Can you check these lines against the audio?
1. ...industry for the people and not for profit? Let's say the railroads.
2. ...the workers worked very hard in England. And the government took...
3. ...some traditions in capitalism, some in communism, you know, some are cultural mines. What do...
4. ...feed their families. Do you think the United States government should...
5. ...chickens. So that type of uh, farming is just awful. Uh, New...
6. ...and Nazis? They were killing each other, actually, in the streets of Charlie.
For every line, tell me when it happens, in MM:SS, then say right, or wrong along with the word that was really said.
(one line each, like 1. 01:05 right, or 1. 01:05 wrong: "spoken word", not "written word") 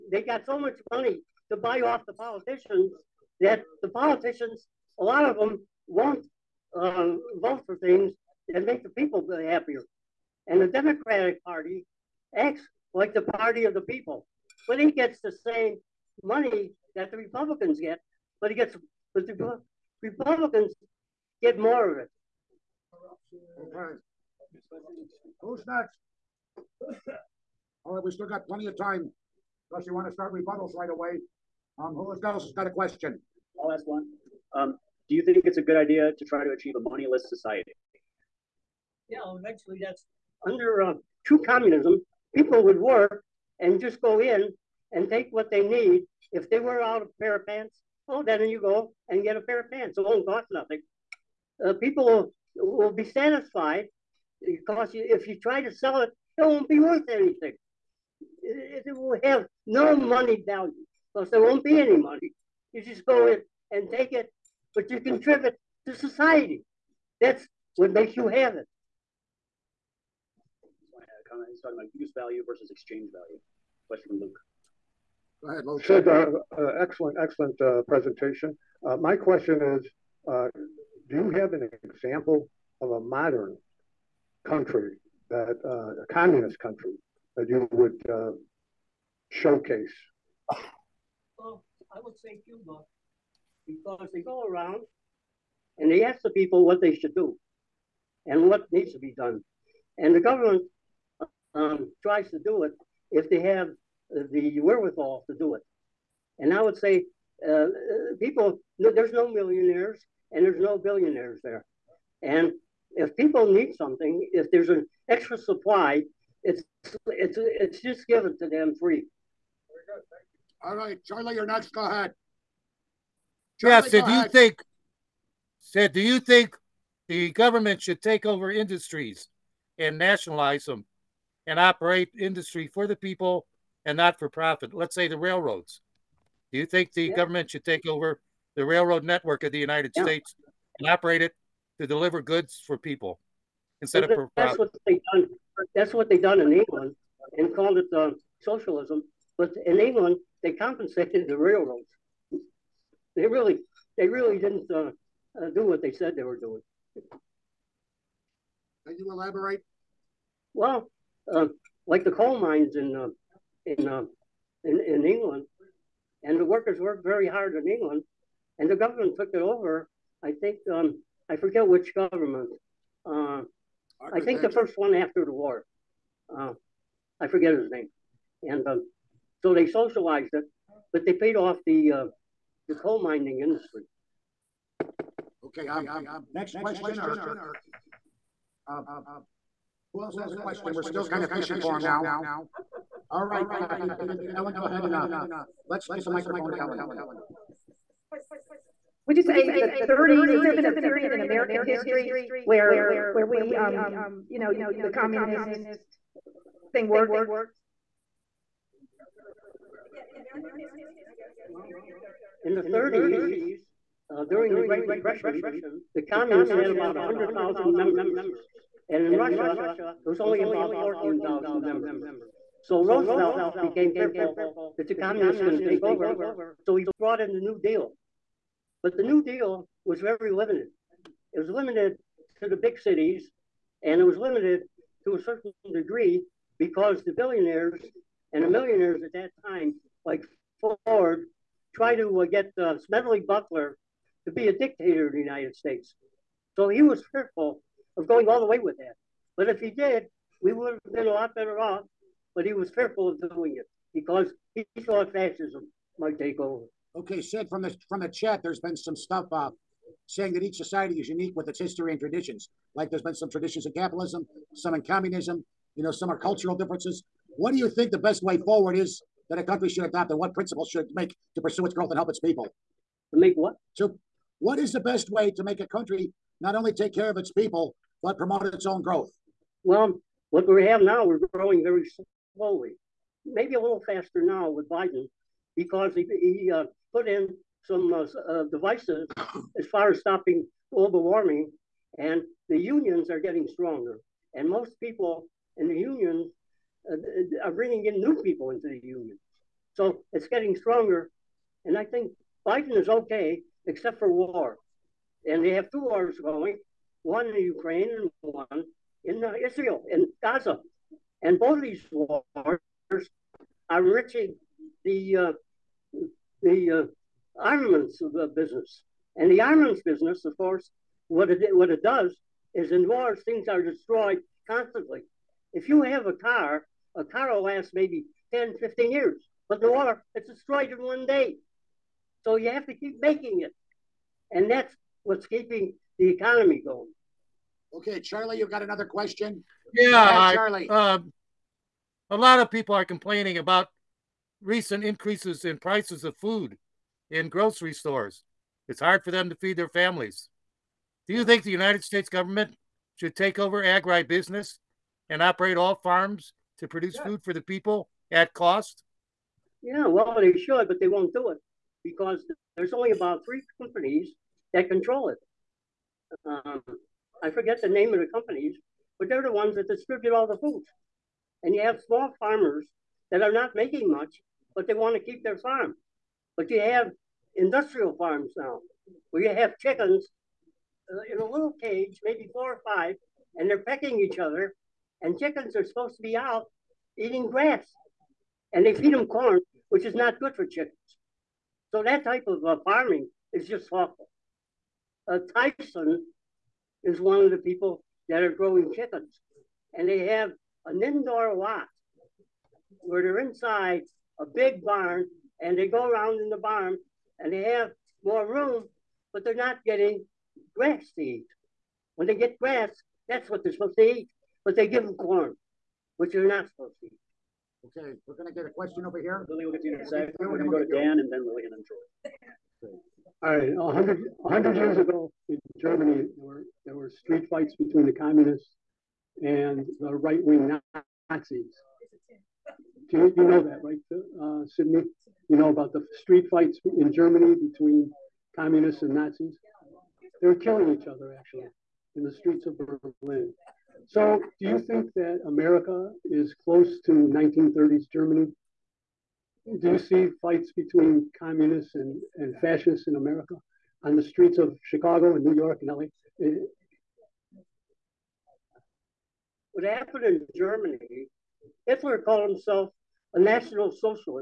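1. 02:12 right
2. 02:46 right
3. 04:23 wrong: "differences", not "mines"
4. 05:49 right
5. 06:30 wrong: "Tyson", not "New"
6. 07:18 wrong: "Berlin", not "Charlie".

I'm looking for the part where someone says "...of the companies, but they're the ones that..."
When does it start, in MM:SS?
06:07.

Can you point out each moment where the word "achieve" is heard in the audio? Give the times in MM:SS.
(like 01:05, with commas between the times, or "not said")
00:36.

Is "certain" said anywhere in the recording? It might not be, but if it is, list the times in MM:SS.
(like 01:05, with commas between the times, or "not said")
03:55.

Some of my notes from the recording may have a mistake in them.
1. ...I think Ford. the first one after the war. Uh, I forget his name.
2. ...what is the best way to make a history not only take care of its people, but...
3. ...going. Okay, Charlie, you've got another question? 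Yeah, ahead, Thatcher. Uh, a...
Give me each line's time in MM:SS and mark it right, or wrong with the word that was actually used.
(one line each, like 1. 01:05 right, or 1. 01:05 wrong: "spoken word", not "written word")
1. 02:54 wrong: "Thatcher", not "Ford"
2. 04:34 wrong: "country", not "history"
3. 05:36 wrong: "Charlie", not "Thatcher".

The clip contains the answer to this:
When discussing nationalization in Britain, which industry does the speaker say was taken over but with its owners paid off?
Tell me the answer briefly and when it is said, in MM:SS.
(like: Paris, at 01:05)
coal mines, at 02:42.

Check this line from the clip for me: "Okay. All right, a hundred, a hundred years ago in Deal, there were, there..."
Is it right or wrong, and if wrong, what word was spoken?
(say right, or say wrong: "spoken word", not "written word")
wrong: "Germany", not "Deal".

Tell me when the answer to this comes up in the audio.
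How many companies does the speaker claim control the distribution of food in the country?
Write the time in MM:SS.
06:03.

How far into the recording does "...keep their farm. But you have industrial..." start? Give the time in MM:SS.
06:14.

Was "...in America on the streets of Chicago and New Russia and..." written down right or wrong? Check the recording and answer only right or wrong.
wrong.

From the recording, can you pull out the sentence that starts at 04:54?
And most people in the unions uh, are bringing in new people into the union.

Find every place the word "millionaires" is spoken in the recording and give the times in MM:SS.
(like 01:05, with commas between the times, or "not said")
01:49, 03:58.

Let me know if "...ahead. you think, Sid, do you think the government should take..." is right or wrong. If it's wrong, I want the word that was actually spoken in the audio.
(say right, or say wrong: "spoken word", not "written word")
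right.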